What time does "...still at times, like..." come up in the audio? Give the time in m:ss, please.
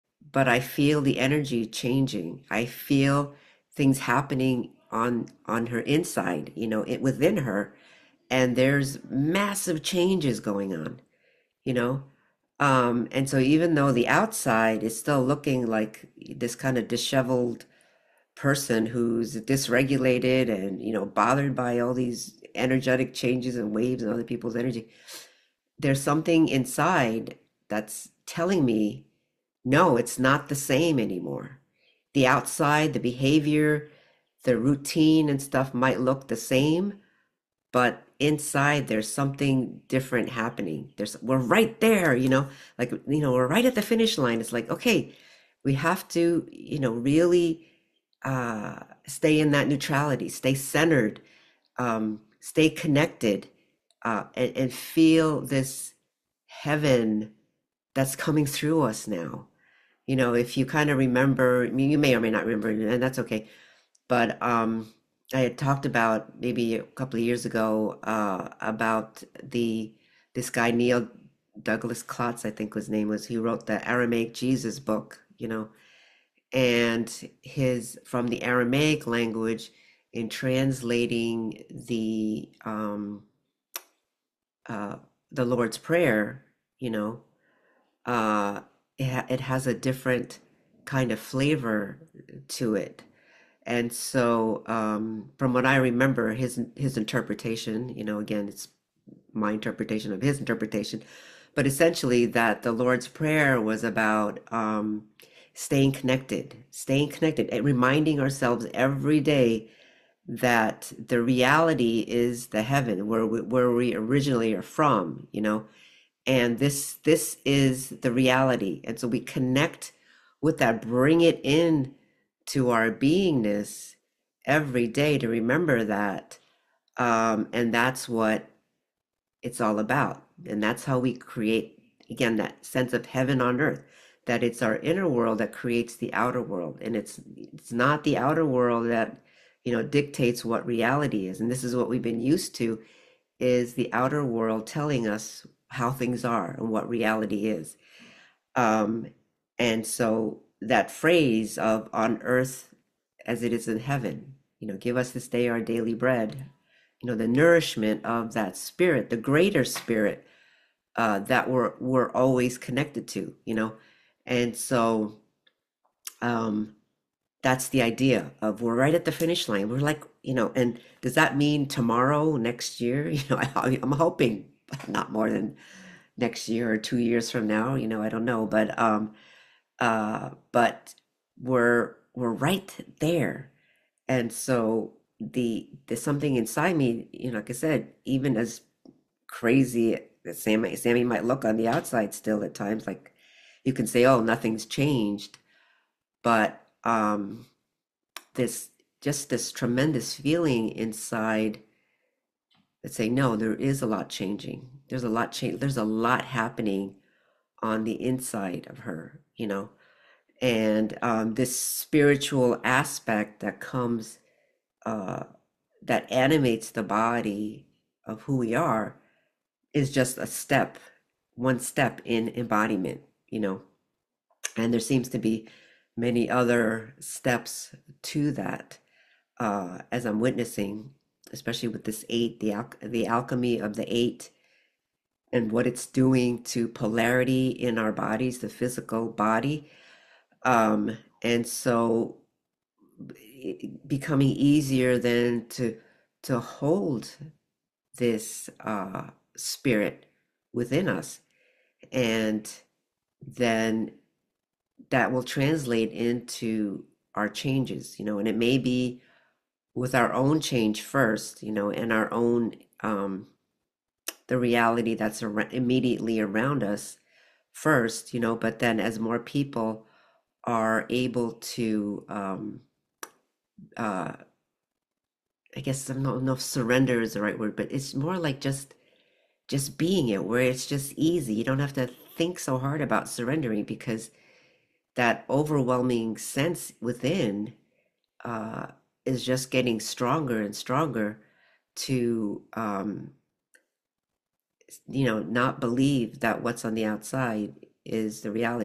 3:12.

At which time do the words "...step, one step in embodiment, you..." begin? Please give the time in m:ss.
3:40.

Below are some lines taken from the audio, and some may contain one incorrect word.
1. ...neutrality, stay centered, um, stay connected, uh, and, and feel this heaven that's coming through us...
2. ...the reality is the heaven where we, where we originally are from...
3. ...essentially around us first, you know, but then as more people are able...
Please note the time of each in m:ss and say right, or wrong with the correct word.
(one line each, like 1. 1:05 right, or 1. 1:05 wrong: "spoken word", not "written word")
1. 0:49 right
2. 1:51 right
3. 4:25 wrong: "immediately", not "essentially".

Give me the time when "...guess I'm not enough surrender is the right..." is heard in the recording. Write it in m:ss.
4:35.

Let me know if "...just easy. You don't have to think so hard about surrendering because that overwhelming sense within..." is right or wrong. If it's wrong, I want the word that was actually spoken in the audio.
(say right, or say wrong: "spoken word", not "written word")
right.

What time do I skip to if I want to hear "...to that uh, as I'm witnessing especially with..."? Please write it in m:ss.
3:48.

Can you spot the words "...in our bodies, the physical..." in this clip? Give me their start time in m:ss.
3:57.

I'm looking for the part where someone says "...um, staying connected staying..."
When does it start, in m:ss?
1:44.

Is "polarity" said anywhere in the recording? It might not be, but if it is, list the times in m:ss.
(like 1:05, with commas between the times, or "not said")
3:56.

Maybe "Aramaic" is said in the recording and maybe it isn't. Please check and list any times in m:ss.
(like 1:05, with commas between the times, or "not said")
1:13, 1:18.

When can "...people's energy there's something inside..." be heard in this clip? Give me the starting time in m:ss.
0:24.